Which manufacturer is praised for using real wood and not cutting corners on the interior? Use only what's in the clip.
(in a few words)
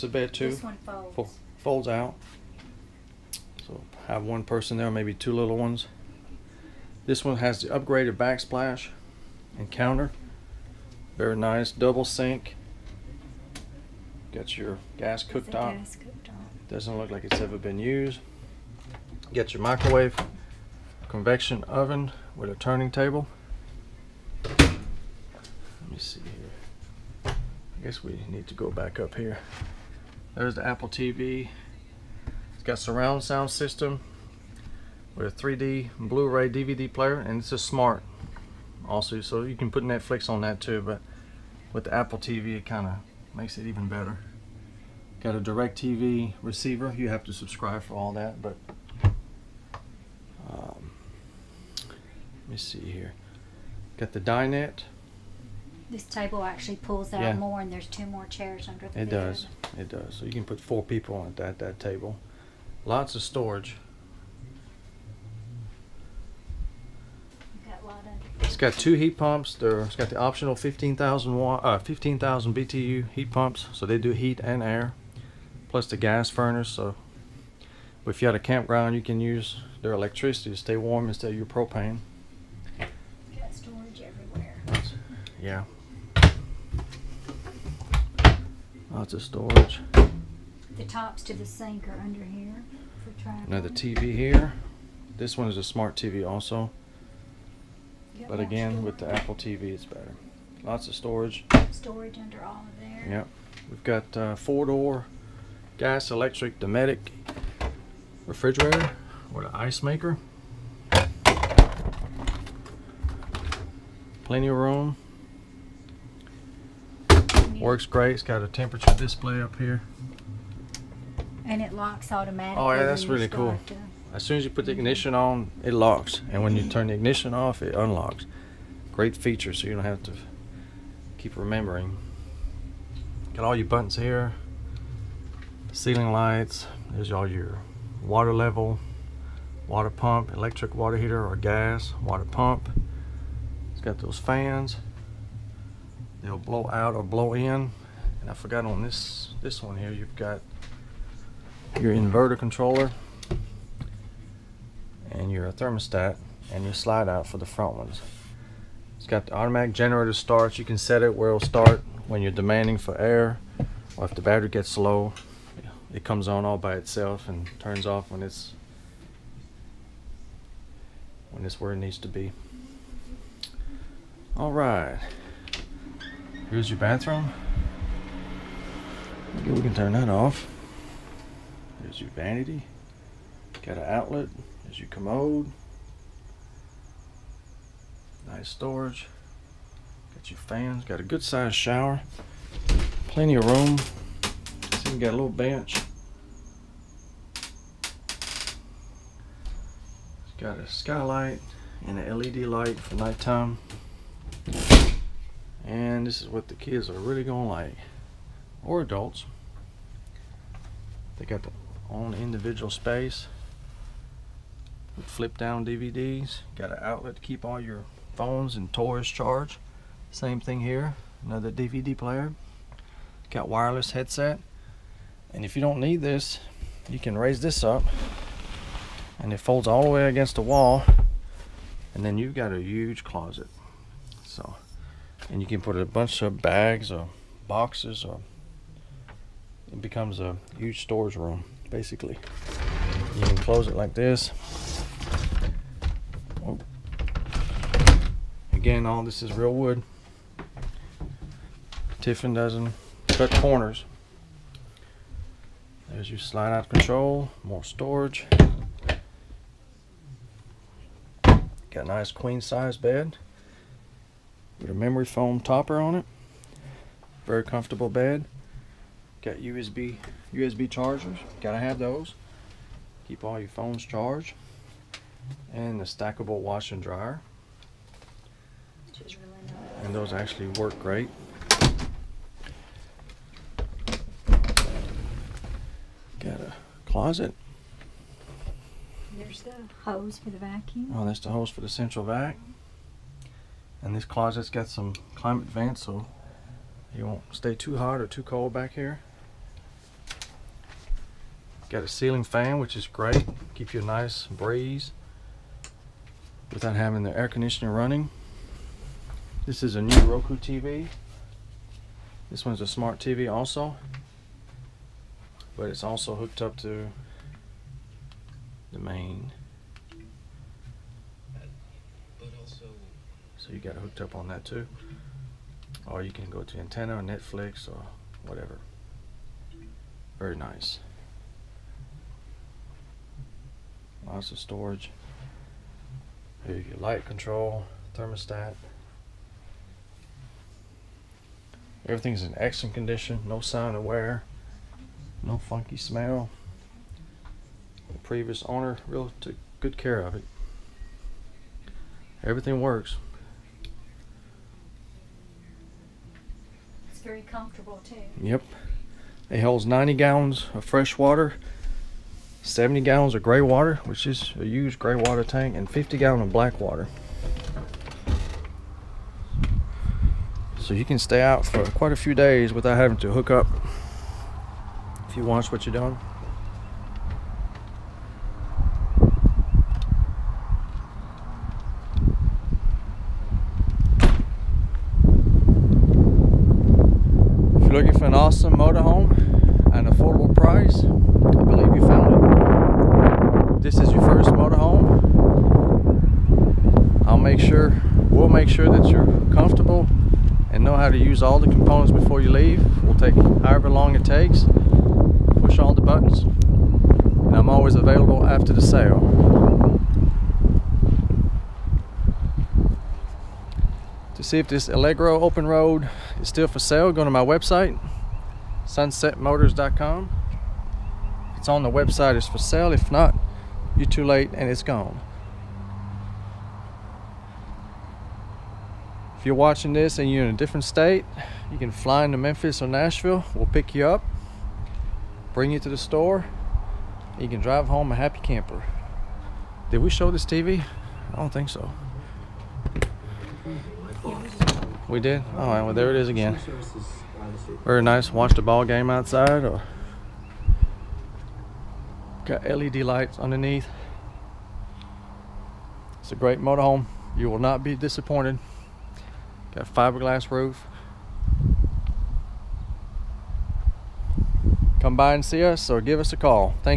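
Tiffin.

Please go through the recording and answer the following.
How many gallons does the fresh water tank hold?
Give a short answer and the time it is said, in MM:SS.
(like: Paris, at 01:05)
90, at 05:59.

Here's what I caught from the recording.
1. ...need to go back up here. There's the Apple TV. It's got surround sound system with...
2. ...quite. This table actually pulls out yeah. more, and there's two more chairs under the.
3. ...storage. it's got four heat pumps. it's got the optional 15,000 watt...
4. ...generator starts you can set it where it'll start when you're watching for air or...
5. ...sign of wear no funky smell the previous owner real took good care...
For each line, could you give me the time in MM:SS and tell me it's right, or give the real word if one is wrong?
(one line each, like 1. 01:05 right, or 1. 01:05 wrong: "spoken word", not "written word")
1. 00:28 right
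2. 00:54 wrong: "dinette", not "quite"
3. 01:03 wrong: "two", not "four"
4. 02:39 wrong: "demanding", not "watching"
5. 05:43 right.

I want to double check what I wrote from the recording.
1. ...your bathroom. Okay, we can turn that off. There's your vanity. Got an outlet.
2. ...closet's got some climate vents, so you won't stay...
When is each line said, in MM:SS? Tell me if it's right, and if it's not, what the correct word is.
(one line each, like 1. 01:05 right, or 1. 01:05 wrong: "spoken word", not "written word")
1. 02:56 right
2. 04:54 right.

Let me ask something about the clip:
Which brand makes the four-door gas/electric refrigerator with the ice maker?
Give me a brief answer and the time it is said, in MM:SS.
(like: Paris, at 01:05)
Dometic, at 01:46.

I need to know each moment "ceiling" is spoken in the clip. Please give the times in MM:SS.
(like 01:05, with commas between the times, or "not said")
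02:15, 05:01.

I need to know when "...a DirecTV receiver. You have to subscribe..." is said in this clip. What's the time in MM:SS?
00:45.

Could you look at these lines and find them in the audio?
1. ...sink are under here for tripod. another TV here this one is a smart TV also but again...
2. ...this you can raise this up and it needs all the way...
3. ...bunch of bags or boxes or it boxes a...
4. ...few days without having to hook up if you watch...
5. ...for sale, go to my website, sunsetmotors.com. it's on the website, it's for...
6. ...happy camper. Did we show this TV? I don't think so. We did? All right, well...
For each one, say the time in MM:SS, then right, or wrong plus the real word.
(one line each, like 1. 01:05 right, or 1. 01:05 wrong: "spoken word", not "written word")
1. 01:31 right
2. 03:46 wrong: "folds", not "needs"
3. 03:55 wrong: "becomes", not "boxes"
4. 06:11 right
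5. 06:56 right
6. 07:17 right.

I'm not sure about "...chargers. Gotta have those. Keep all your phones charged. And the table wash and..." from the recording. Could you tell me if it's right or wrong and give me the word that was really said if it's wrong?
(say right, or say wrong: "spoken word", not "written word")
wrong: "stackable", not "table".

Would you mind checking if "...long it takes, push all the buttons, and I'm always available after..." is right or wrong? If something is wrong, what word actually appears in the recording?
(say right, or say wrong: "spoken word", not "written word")
right.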